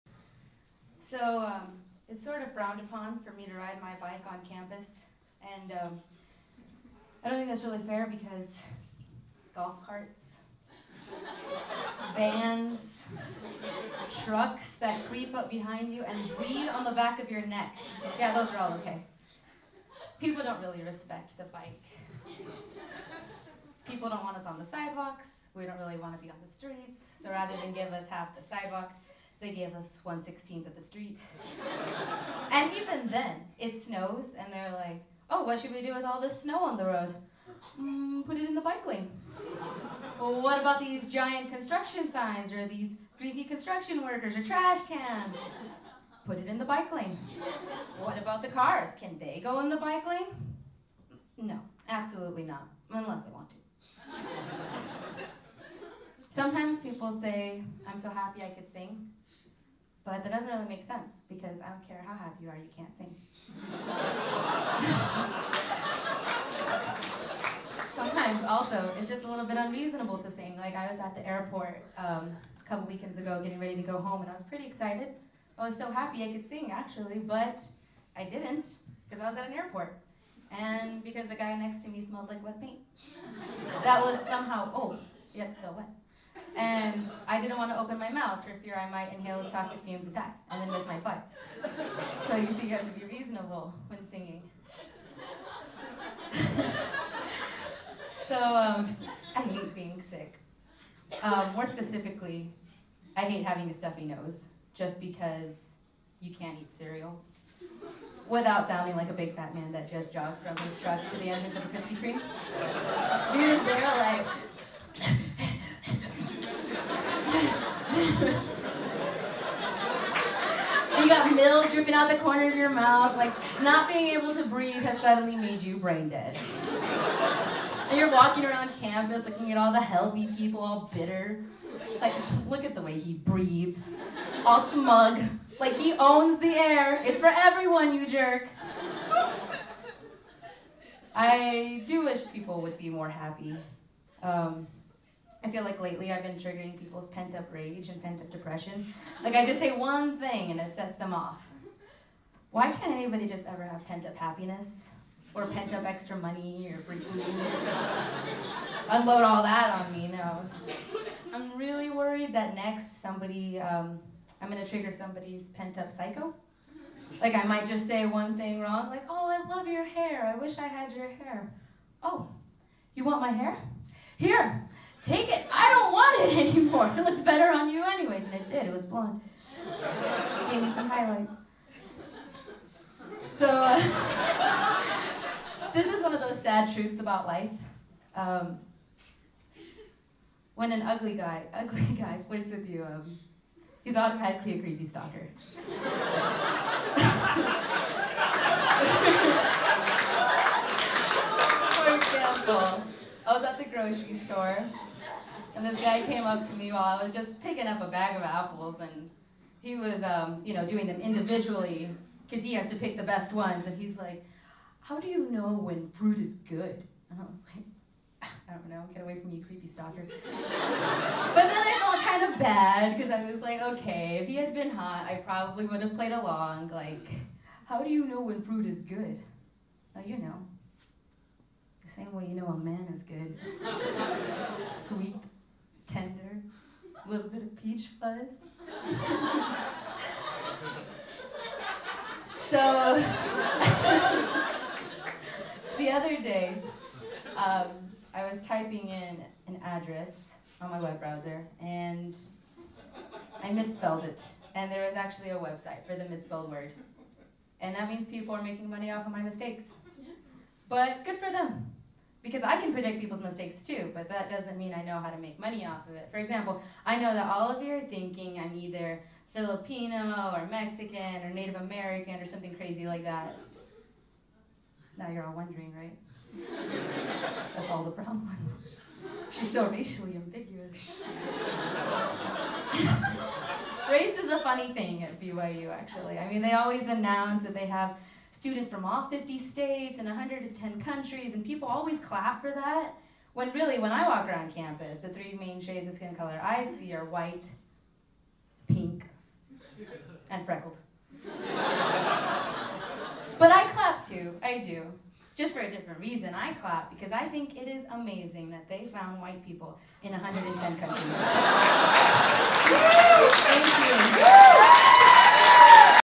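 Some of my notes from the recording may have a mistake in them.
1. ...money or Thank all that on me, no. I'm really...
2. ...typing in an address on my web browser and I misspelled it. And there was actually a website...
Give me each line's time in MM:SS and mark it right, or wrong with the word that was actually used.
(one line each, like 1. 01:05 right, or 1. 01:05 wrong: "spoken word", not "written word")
1. 02:36 wrong: "Unload", not "Thank"
2. 04:08 right.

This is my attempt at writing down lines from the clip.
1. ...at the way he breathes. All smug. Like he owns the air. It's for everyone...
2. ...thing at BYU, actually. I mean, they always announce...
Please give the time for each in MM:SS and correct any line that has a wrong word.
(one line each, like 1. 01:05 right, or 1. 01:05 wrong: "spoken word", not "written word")
1. 02:12 right
2. 04:44 right.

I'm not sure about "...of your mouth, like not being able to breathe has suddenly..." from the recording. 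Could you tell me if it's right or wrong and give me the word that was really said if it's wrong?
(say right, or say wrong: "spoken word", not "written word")
right.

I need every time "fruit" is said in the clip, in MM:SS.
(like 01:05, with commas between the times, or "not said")
03:35, 03:48.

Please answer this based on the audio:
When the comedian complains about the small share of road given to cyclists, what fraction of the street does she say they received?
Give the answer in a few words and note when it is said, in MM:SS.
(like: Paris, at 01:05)
1/116, at 00:30.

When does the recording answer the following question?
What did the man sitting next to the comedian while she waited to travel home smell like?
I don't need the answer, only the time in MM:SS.
01:22.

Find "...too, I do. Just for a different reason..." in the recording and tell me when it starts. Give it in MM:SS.
05:04.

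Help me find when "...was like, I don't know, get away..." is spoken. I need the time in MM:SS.
03:37.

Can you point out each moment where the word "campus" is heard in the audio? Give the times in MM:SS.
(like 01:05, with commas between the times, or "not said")
00:04, 02:08, 04:54.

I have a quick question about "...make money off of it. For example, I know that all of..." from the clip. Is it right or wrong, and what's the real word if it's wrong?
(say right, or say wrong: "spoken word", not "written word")
right.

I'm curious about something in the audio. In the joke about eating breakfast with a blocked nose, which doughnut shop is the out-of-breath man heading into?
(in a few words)
Krispy Kreme.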